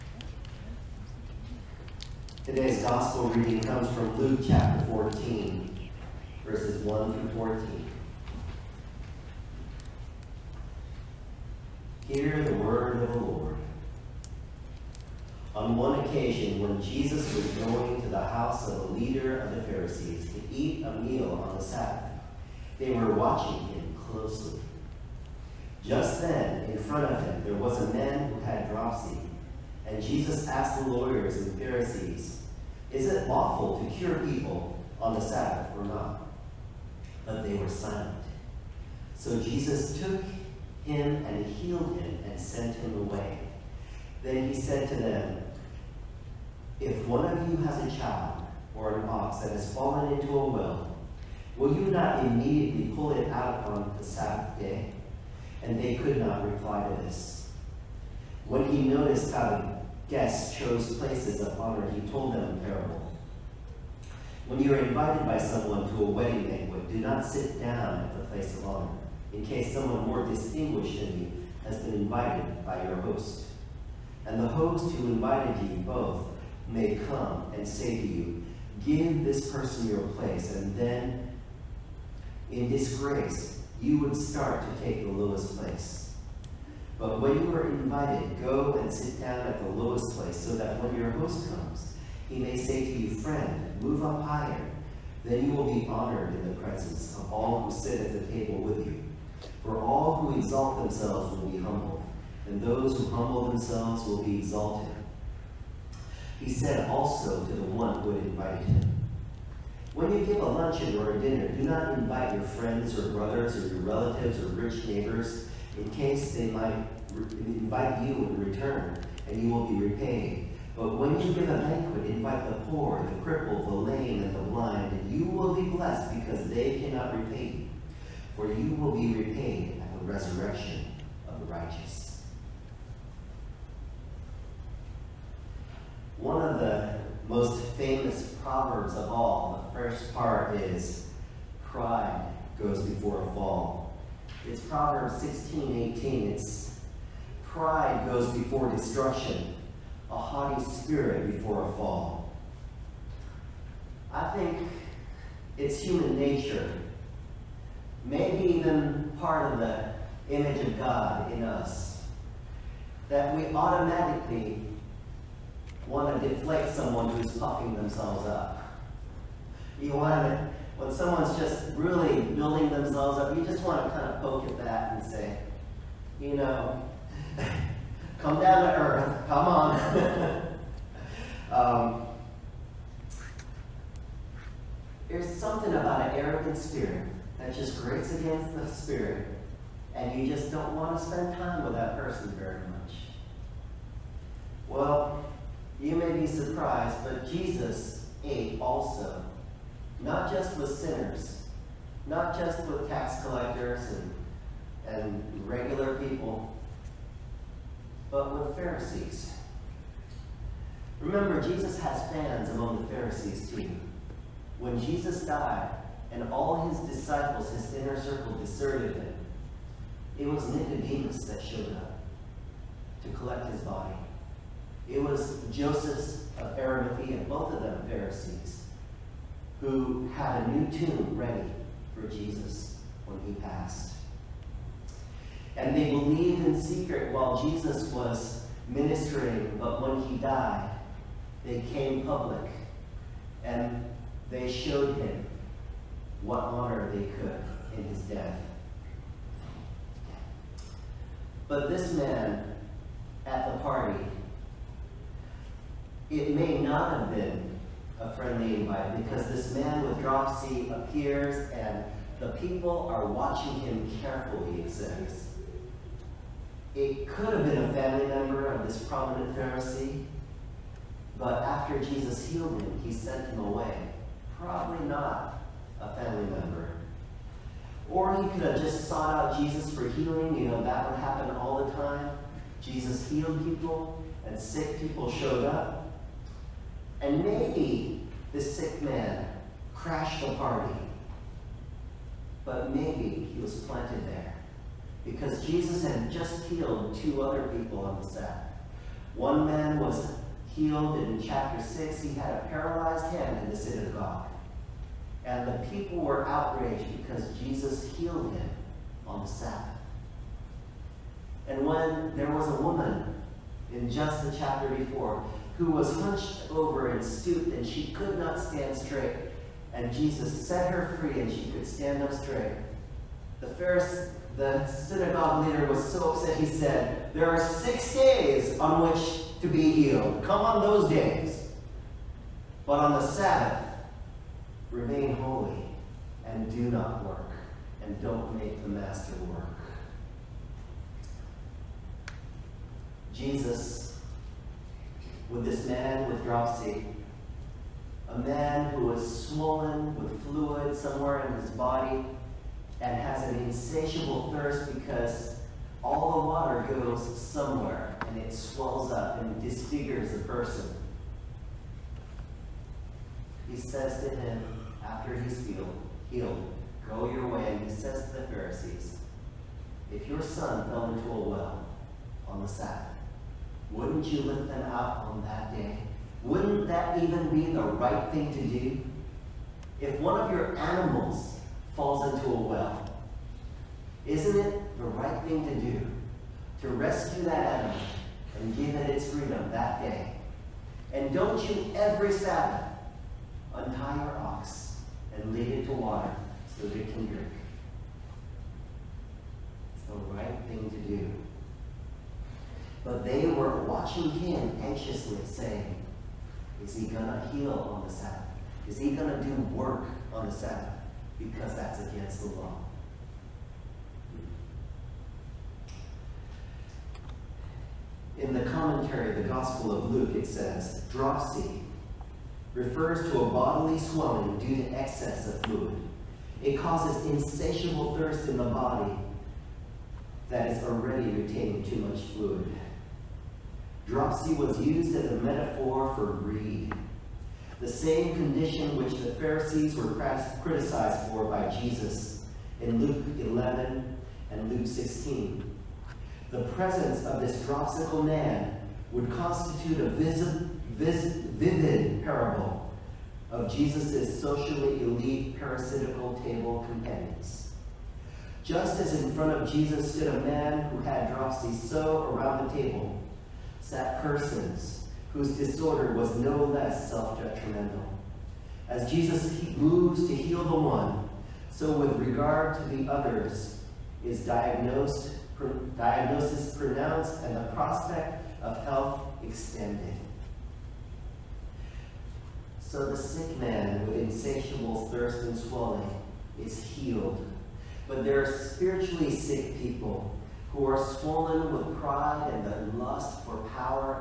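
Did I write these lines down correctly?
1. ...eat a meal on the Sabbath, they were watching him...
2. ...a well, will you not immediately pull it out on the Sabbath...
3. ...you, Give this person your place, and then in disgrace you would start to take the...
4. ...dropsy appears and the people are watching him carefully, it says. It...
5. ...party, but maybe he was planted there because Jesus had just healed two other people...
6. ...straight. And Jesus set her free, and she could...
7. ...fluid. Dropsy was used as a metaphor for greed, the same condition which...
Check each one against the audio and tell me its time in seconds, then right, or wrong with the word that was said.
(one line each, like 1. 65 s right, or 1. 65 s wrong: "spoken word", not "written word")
1. 20 s right
2. 50 s right
3. 78 s right
4. 259 s right
5. 290 s right
6. 318 s right
7. 432 s right.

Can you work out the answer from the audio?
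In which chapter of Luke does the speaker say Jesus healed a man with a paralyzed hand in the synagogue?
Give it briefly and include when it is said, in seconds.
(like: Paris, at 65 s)
Chapter 6, at 301 s.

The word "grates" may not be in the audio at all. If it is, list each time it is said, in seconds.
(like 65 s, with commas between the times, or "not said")
187 s.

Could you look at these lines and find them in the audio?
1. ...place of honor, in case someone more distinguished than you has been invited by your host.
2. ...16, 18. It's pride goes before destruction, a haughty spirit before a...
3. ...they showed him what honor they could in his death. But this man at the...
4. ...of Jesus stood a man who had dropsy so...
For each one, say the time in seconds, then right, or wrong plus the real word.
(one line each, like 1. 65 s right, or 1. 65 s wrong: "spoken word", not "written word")
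1. 68 s right
2. 145 s right
3. 244 s right
4. 459 s right.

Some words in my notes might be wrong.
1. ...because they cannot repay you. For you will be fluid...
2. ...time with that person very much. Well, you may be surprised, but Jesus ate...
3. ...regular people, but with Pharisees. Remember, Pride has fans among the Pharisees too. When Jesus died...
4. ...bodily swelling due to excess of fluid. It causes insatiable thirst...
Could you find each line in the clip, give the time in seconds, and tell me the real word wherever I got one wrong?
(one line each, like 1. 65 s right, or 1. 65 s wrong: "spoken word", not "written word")
1. 126 s wrong: "repaid", not "fluid"
2. 191 s right
3. 205 s wrong: "Jesus", not "Pride"
4. 423 s right.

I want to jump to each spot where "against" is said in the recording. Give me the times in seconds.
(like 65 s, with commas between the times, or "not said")
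188 s, 411 s.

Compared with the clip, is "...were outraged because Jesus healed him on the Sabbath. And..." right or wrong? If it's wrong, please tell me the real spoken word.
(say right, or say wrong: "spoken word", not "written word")
right.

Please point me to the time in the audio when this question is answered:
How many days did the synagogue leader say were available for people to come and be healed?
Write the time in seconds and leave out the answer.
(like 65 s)
327 s.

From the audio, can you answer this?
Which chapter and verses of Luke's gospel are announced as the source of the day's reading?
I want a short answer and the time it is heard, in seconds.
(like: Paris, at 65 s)
Chapter 14, verses 1-14, at 4 s.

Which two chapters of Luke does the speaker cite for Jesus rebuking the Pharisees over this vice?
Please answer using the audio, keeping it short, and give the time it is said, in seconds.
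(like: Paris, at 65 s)
Luke 11 and Luke 16, at 442 s.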